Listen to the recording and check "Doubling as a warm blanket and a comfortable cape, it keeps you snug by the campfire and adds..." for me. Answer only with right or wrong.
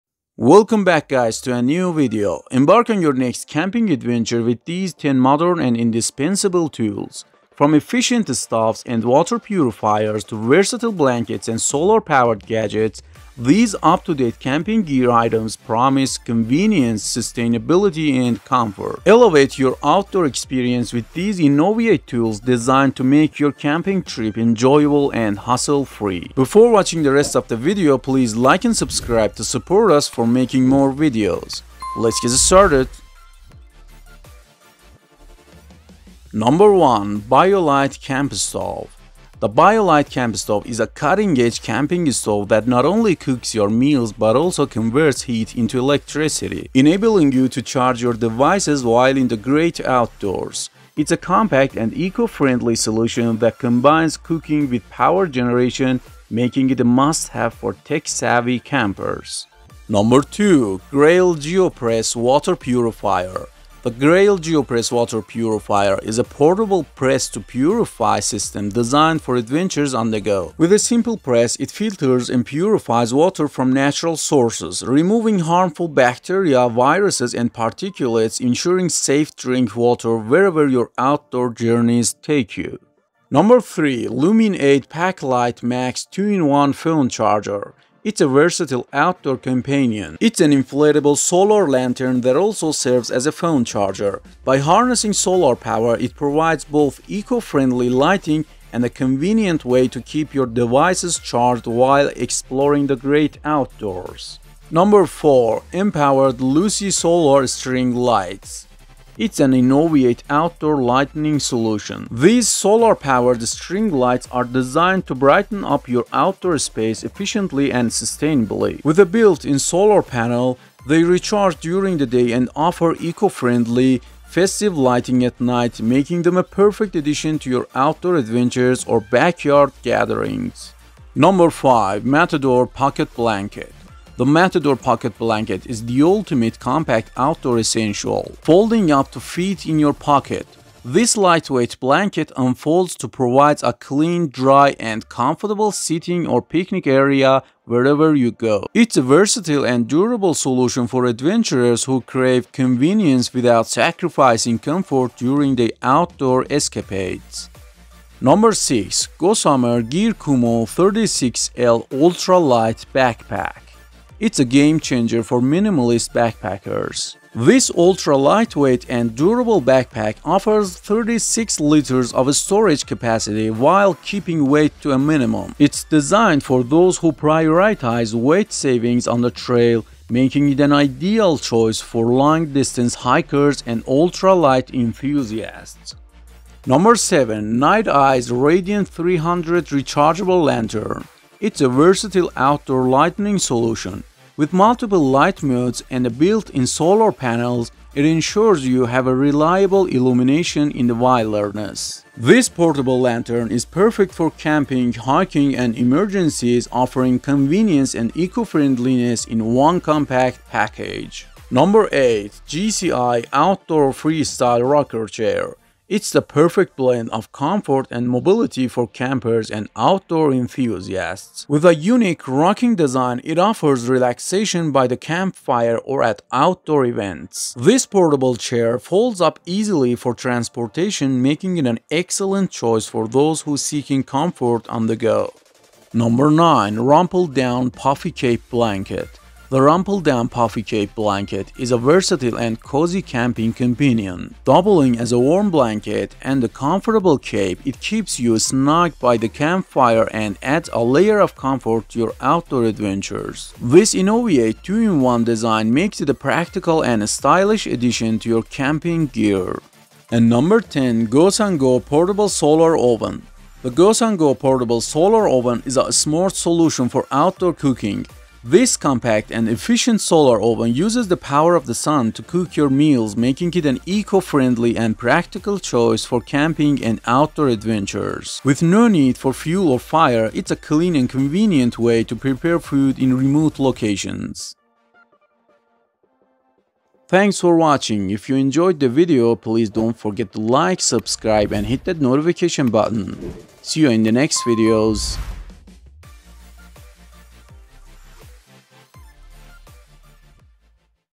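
right.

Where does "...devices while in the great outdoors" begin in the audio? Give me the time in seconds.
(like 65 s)
48 s.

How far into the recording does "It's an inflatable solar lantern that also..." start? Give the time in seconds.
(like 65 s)
90 s.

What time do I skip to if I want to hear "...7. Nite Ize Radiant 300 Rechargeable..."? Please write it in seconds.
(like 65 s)
186 s.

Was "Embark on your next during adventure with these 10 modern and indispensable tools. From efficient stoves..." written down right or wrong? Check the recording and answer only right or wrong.
wrong.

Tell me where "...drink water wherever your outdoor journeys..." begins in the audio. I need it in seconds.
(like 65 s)
79 s.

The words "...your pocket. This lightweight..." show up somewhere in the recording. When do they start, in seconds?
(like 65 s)
139 s.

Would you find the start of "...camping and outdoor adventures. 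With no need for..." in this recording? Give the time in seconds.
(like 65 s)
276 s.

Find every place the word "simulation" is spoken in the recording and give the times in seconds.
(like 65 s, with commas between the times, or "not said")
not said.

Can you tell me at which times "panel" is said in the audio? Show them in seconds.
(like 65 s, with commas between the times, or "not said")
120 s, 197 s.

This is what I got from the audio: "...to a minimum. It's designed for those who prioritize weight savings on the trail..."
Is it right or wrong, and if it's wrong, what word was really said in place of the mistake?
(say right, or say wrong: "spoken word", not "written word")
right.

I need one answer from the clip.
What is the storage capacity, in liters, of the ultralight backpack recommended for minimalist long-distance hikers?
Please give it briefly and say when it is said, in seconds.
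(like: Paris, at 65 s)
36 liters, at 170 s.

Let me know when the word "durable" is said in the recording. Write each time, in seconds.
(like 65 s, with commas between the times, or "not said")
149 s, 169 s.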